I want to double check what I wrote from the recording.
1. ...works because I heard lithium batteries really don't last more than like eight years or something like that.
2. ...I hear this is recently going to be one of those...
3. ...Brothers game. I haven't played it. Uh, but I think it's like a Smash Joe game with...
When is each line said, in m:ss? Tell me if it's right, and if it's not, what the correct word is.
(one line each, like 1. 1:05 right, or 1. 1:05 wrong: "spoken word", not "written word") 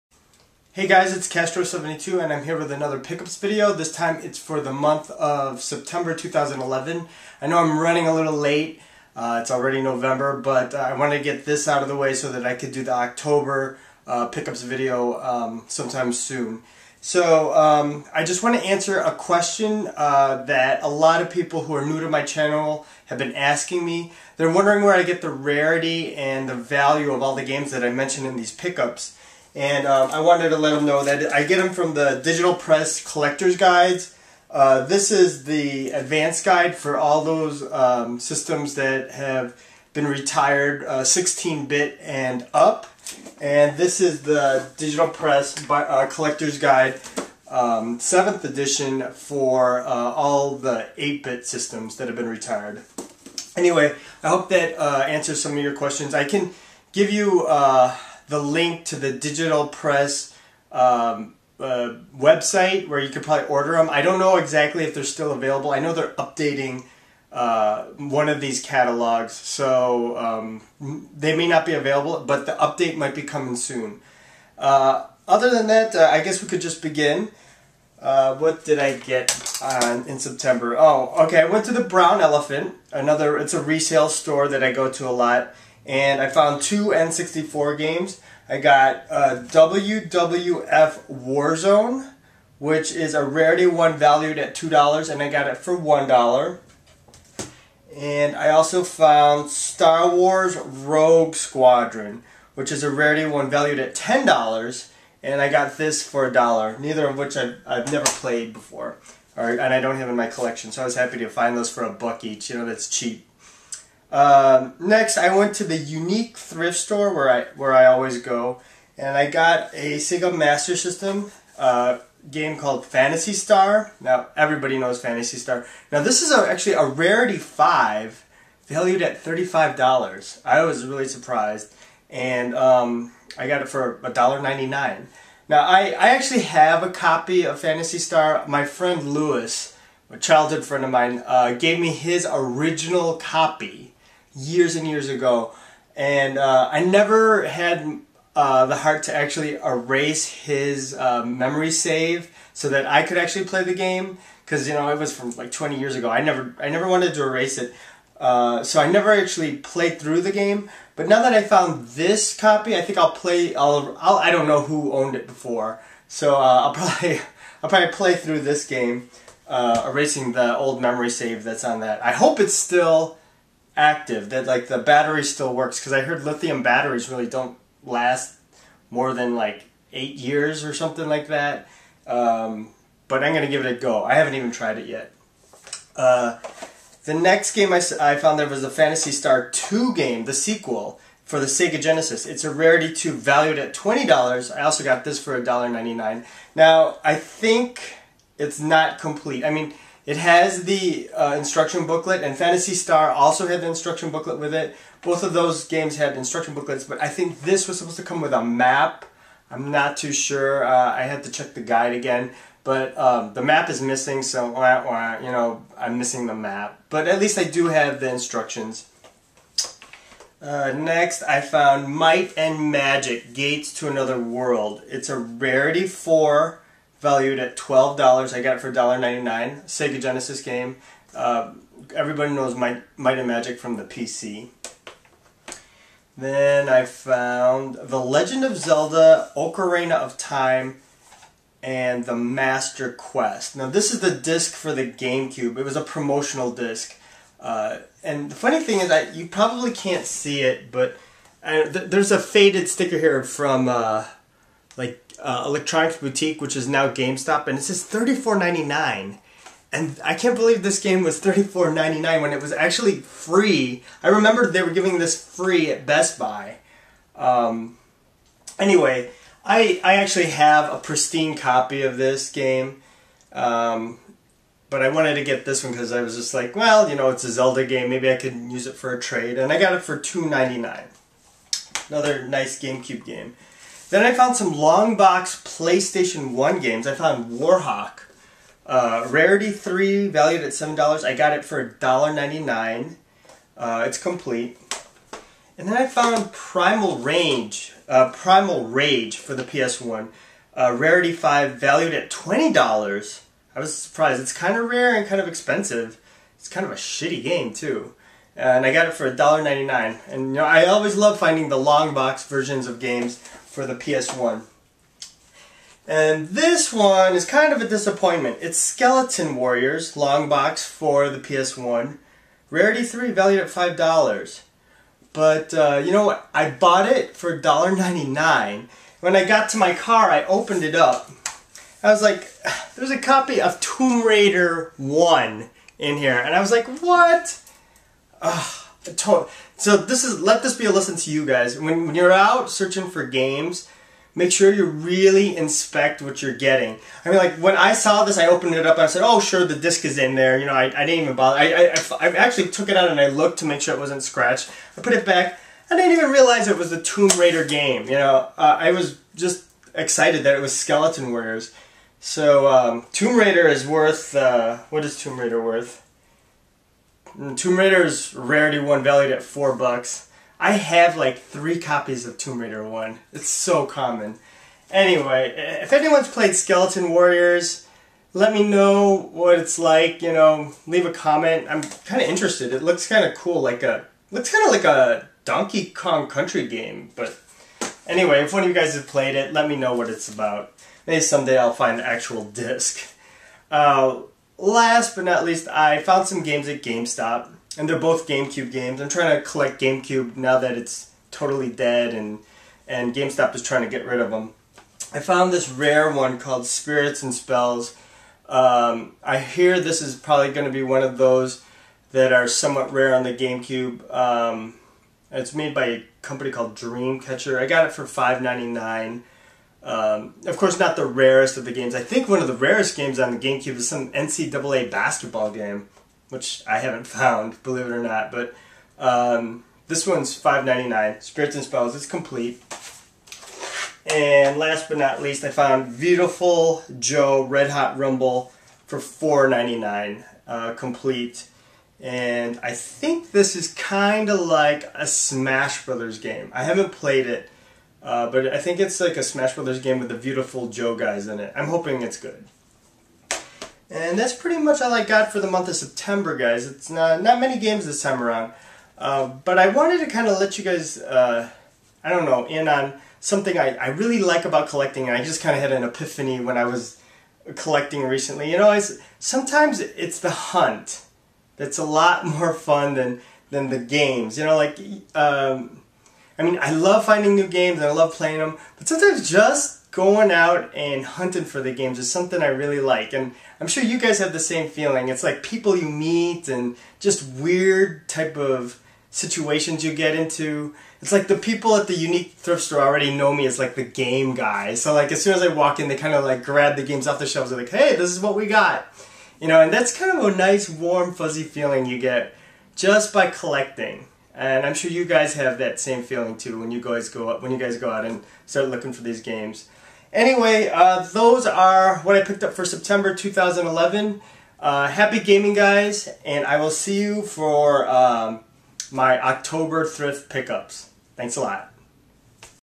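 1. 2:55 right
2. 6:49 wrong: "probably", not "recently"
3. 7:25 wrong: "Brothers", not "Joe".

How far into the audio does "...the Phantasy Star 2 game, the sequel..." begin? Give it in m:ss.
3:08.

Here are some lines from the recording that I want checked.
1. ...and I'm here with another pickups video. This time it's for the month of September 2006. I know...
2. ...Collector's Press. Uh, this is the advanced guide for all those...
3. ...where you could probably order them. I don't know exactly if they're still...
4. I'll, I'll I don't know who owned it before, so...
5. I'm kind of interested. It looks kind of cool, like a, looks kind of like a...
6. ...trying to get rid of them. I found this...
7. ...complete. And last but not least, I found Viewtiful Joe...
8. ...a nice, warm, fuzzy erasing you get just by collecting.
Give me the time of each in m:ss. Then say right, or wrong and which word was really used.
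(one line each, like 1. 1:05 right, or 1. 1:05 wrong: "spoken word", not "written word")
1. 0:02 wrong: "2011", not "2006"
2. 0:33 wrong: "Guides", not "Press"
3. 1:02 right
4. 2:43 right
5. 6:21 right
6. 6:43 right
7. 7:11 right
8. 8:20 wrong: "feeling", not "erasing".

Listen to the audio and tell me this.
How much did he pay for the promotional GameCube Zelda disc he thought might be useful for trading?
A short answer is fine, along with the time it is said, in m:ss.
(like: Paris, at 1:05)
$2.99, at 4:39.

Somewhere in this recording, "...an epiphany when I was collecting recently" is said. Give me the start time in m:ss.
7:45.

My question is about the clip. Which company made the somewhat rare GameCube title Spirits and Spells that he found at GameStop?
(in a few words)
Dreamcatcher.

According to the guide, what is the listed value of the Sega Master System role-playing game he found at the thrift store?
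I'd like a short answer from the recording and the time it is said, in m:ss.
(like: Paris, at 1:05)
$35, at 2:09.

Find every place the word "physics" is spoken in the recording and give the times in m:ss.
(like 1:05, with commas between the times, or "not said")
not said.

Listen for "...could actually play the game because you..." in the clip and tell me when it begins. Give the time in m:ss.
2:33.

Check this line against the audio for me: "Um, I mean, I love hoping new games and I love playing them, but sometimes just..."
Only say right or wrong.
wrong.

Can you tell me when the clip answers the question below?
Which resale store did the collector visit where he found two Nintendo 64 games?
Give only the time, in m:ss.
1:21.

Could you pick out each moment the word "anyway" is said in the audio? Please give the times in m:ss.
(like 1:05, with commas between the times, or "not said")
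0:53, 4:28, 6:14, 6:27, 8:29.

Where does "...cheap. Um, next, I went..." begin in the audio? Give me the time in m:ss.
1:52.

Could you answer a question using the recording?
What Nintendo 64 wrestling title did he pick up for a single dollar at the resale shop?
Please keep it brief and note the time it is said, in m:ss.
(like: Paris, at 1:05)
WWF Warzone, at 1:29.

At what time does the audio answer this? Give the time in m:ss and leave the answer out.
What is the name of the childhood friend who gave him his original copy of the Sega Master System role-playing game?
2:19.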